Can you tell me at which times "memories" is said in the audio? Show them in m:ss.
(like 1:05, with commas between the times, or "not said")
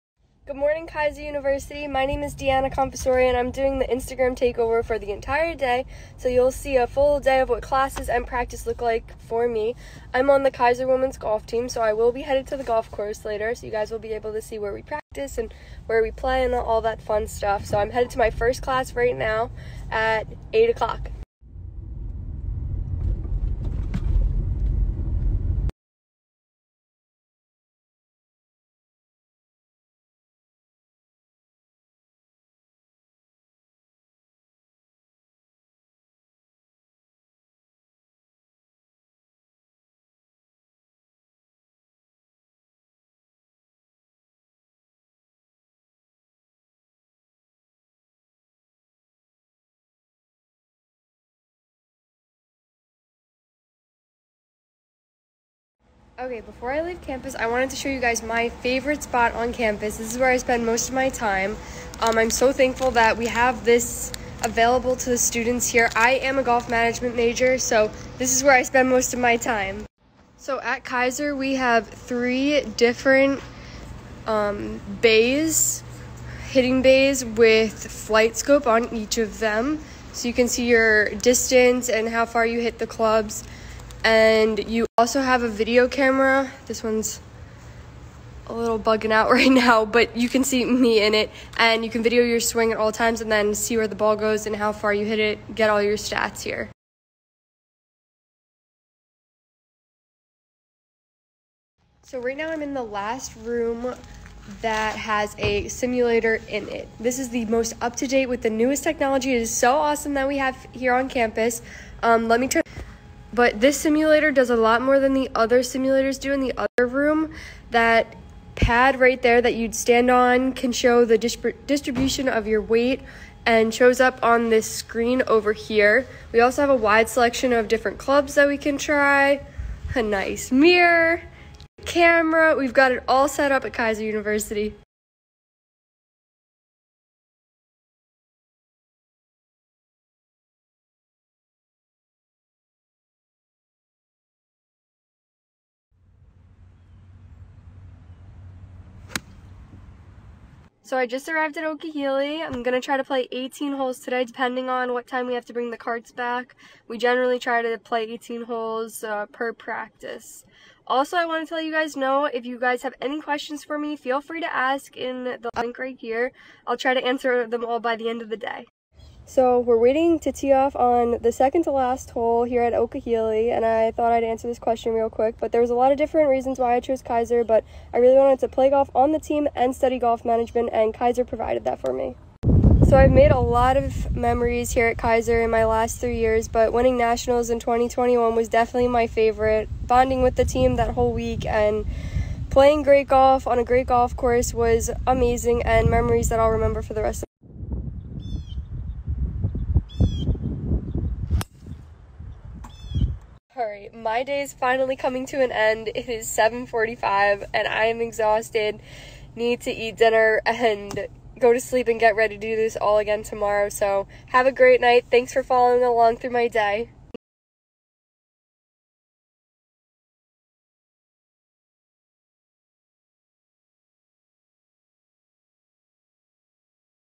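3:04, 3:15.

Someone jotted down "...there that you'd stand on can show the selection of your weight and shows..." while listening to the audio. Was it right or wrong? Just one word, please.
wrong.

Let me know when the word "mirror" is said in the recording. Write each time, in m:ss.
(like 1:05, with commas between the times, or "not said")
2:10.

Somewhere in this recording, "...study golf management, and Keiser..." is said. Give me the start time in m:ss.
2:59.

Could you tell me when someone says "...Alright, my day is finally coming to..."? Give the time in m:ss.
3:23.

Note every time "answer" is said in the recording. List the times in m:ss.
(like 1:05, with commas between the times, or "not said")
2:47, 2:54.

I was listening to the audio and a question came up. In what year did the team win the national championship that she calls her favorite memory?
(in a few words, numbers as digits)
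2021.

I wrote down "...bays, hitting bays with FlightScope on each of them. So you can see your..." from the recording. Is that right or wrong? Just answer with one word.
right.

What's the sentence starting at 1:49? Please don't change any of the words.
It is so awesome that we have here on campus.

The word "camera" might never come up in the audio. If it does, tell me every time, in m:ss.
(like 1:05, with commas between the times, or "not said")
1:25, 2:11.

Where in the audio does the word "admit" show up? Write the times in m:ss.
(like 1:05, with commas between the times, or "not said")
not said.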